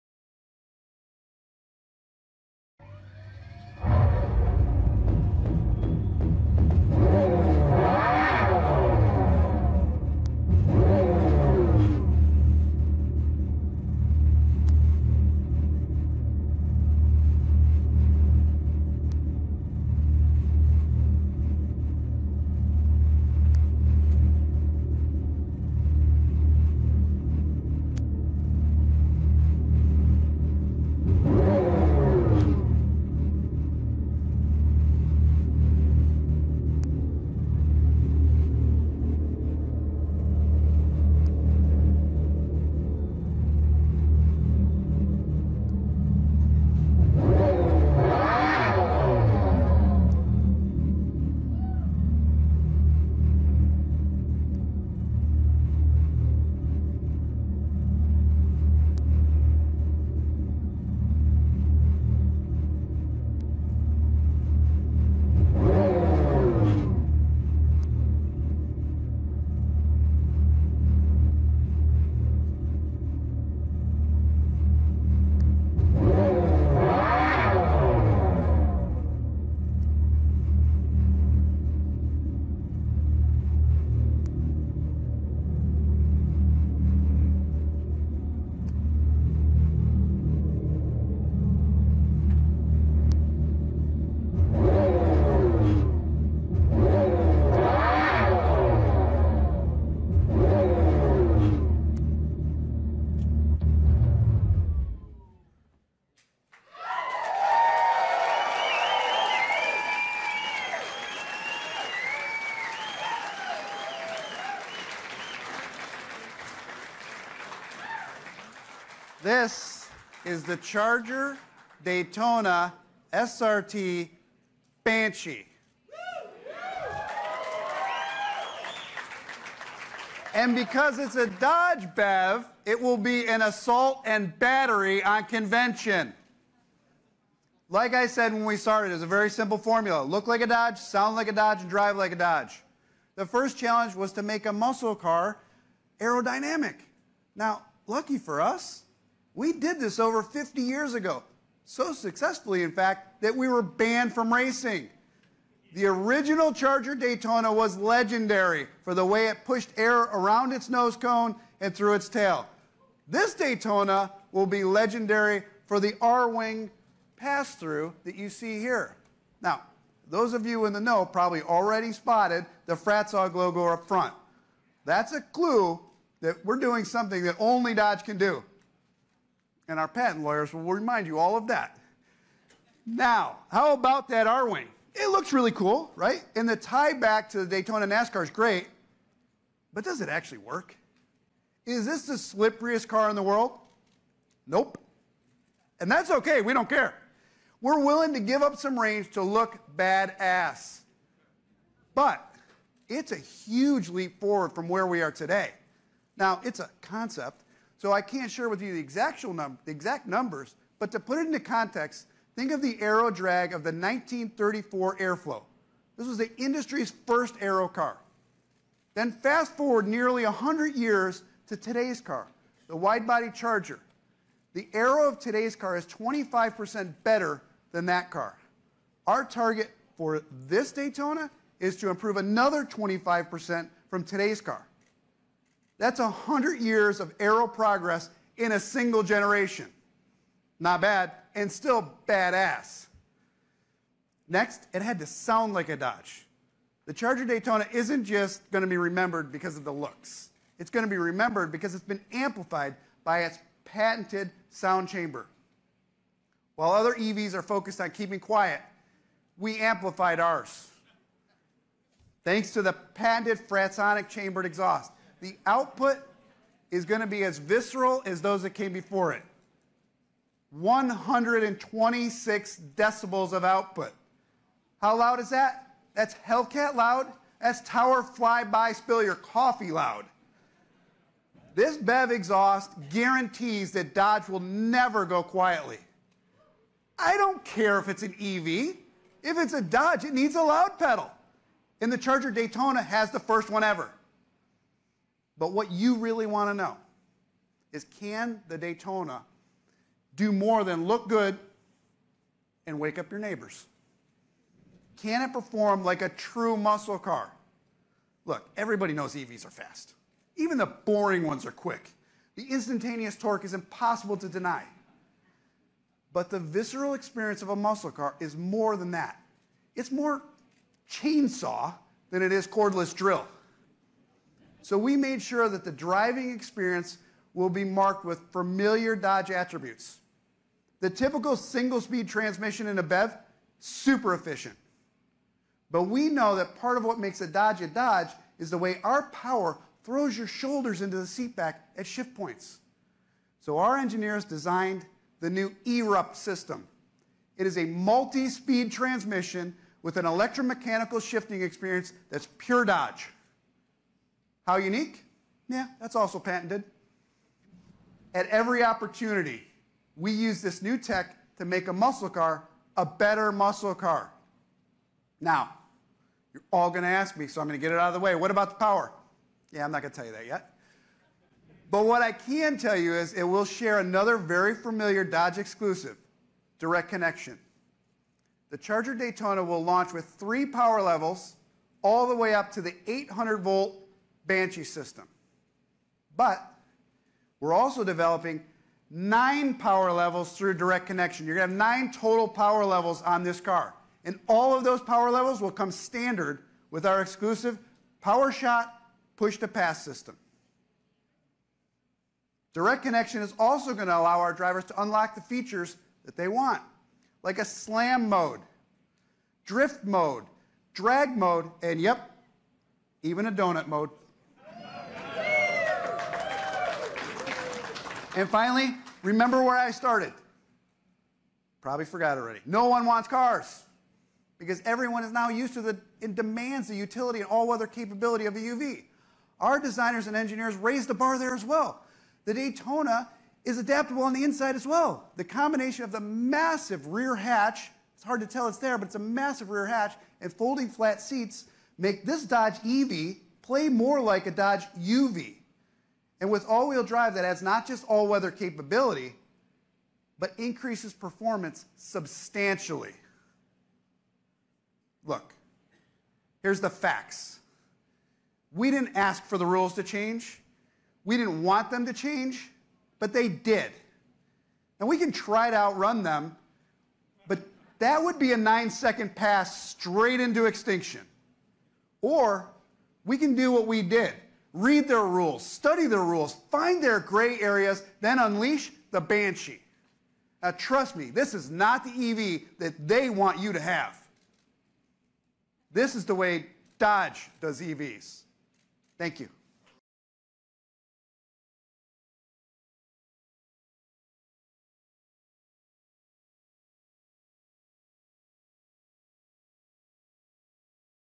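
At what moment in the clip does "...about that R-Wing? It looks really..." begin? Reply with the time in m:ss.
3:03.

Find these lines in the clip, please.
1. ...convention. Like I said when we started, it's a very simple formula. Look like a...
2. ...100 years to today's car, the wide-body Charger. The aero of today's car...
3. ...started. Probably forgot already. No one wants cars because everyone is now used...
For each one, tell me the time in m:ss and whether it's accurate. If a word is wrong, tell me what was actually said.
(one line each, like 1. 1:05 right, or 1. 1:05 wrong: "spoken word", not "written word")
1. 2:15 right
2. 3:40 right
3. 6:59 right.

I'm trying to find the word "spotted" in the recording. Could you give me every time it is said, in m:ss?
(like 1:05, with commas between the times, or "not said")
2:51.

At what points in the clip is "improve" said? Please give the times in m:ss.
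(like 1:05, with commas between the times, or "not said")
3:51.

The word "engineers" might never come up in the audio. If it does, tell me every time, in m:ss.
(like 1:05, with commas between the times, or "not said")
5:43, 7:10.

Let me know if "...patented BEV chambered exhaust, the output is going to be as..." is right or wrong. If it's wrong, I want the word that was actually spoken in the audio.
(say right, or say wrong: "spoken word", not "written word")
wrong: "Fratzonic", not "BEV".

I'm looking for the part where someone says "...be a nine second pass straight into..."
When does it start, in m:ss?
7:48.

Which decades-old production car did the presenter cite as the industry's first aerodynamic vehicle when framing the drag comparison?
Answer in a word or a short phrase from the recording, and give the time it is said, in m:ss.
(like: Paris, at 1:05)
1934 Airflow, at 3:33.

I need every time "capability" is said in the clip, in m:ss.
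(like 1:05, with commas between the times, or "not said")
7:07, 7:28.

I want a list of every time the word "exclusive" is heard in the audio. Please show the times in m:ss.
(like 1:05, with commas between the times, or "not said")
6:15, 6:37.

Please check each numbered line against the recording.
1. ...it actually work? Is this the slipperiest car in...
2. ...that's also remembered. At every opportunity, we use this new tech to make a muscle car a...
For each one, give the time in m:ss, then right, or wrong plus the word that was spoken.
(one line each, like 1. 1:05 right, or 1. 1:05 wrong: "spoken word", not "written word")
1. 3:10 right
2. 5:55 wrong: "patented", not "remembered".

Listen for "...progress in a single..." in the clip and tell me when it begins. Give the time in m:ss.
3:57.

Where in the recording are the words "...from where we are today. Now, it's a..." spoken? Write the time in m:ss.
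3:24.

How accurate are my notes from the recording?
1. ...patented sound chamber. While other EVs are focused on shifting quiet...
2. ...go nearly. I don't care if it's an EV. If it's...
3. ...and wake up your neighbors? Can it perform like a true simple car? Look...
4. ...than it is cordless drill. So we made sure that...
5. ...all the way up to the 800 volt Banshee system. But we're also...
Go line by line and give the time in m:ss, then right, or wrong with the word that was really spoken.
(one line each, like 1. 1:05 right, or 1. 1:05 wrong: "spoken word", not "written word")
1. 4:13 wrong: "keeping", not "shifting"
2. 4:45 wrong: "quietly", not "nearly"
3. 5:02 wrong: "muscle", not "simple"
4. 5:22 right
5. 6:21 right.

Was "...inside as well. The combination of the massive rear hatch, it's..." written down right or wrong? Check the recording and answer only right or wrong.
right.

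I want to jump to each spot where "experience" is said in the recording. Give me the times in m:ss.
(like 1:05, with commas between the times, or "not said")
5:16, 5:26, 5:51.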